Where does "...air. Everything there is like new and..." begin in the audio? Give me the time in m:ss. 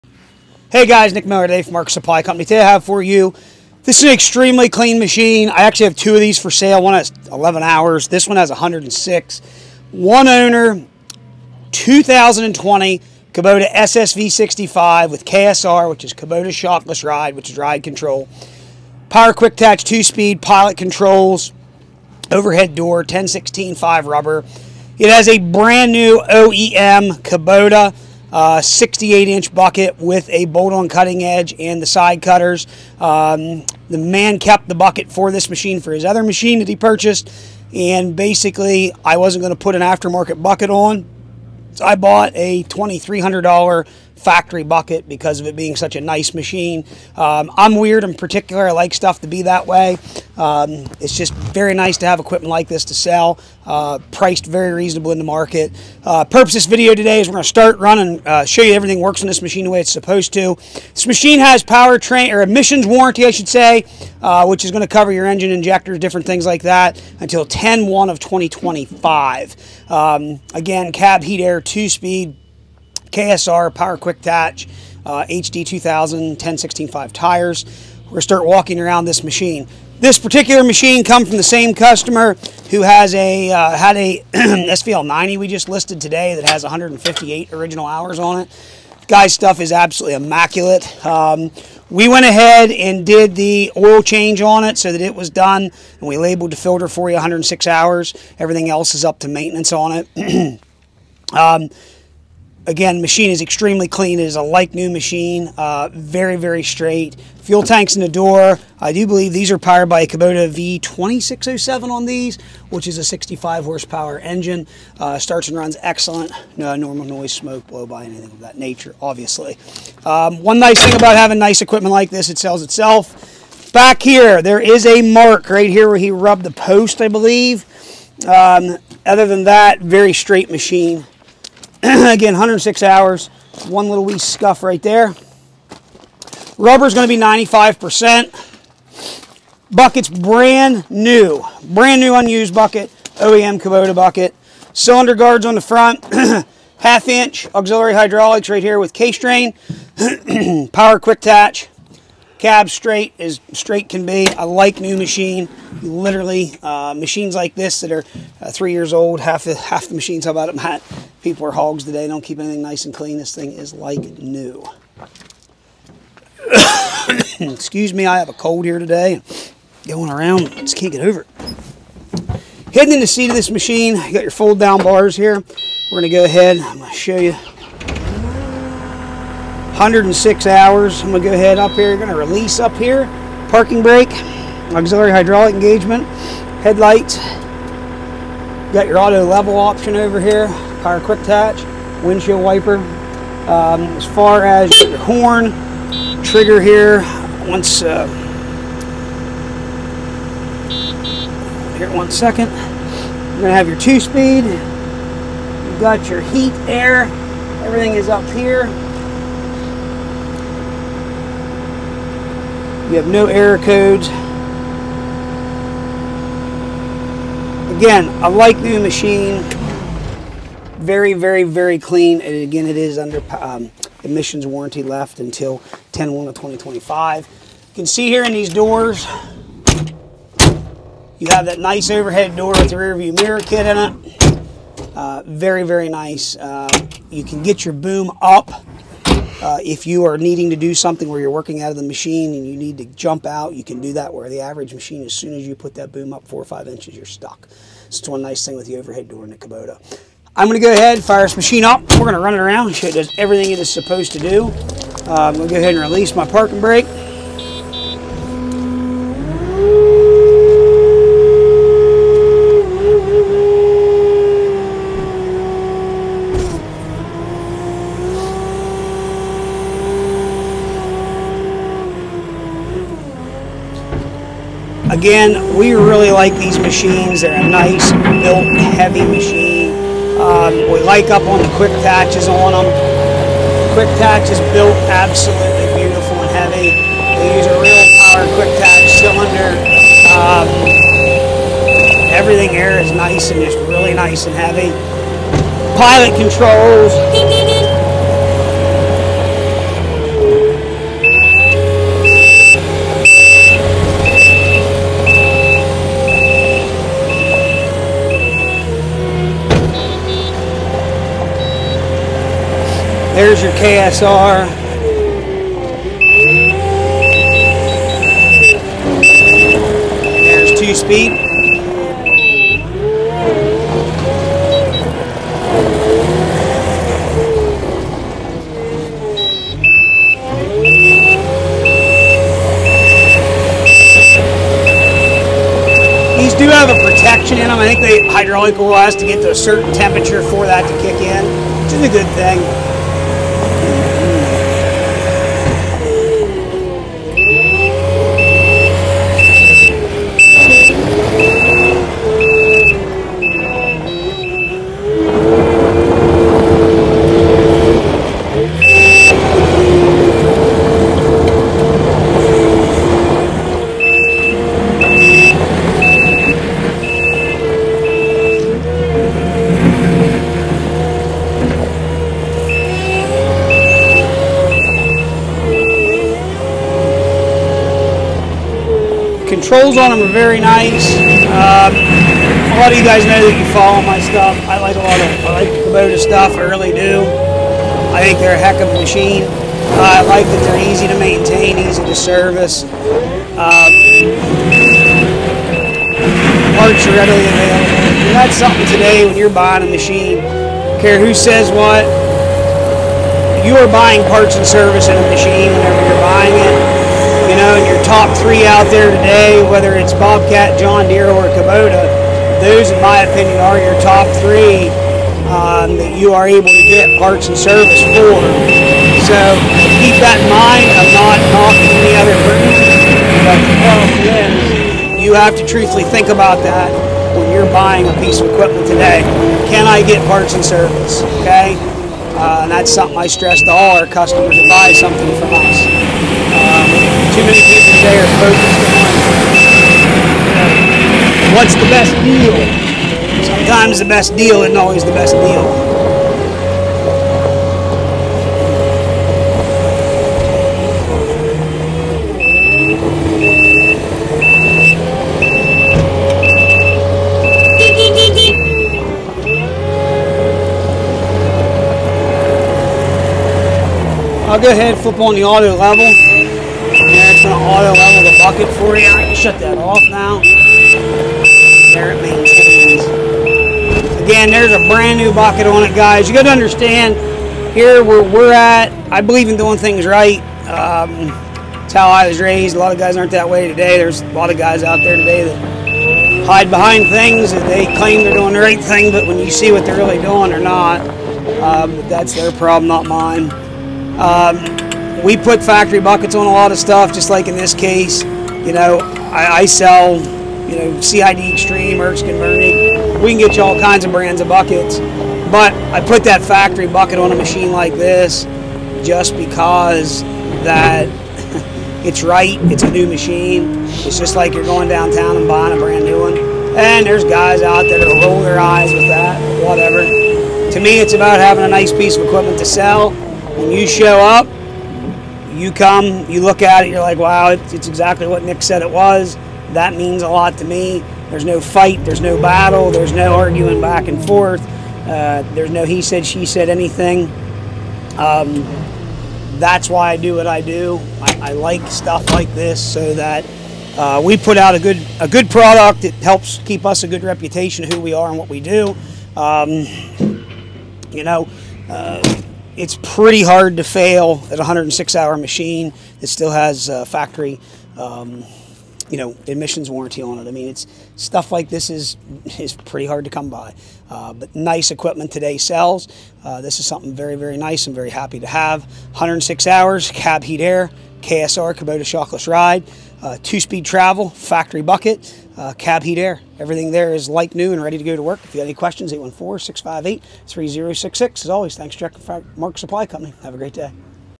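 9:35.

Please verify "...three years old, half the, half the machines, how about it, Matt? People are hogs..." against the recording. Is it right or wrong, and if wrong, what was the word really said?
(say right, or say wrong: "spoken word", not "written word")
right.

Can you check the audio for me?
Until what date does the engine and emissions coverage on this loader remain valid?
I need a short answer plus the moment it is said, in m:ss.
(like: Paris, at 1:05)
10-1 of 2025, at 1:07.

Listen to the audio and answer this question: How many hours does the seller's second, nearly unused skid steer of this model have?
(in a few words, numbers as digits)
11.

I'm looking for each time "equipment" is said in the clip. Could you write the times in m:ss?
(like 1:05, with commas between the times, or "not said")
0:52, 2:01, 7:08, 8:42, 9:24.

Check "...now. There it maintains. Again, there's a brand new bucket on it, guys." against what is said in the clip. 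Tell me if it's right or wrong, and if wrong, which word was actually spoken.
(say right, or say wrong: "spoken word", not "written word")
right.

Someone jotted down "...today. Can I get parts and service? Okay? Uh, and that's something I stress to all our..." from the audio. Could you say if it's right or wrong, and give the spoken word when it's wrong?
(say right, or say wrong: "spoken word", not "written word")
right.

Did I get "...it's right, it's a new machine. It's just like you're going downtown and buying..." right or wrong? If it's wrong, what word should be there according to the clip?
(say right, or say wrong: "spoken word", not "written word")
right.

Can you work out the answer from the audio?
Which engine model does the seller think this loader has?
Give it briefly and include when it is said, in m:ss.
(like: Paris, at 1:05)
Kubota V2607, at 1:50.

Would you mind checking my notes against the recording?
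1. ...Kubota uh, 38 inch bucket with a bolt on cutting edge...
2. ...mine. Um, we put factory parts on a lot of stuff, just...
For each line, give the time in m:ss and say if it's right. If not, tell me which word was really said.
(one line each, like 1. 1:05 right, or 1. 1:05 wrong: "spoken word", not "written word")
1. 0:27 wrong: "68", not "38"
2. 8:12 wrong: "buckets", not "parts".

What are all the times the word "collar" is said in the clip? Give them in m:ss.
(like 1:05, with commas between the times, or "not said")
not said.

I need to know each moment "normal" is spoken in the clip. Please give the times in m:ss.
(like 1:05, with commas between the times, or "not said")
1:56.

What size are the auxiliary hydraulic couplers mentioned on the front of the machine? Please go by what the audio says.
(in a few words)
Half inch.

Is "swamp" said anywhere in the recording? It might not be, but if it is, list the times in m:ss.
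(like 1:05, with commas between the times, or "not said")
not said.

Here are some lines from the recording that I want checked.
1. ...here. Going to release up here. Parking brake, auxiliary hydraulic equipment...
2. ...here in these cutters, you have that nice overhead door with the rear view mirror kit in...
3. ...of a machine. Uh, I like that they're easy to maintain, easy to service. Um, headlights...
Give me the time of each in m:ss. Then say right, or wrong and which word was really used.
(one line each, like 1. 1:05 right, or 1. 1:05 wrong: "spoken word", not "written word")
1. 3:01 wrong: "engagement", not "equipment"
2. 3:48 wrong: "doors", not "cutters"
3. 6:28 wrong: "parts", not "headlights".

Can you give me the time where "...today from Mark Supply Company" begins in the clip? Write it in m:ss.
0:01.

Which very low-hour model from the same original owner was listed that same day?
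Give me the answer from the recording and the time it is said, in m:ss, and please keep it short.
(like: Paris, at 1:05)
SVL 90, at 1:24.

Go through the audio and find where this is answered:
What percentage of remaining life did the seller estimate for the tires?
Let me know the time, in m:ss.
2:17.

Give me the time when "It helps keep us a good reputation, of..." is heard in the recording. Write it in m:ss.
9:05.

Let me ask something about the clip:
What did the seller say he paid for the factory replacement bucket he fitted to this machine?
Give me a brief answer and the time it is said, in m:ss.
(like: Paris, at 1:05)
$2,300, at 0:42.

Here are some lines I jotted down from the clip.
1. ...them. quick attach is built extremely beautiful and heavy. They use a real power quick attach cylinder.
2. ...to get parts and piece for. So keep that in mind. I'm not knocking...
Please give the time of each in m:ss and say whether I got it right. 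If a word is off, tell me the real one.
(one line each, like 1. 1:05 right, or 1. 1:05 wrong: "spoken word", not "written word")
1. 4:42 wrong: "absolutely", not "extremely"
2. 6:56 wrong: "service", not "piece".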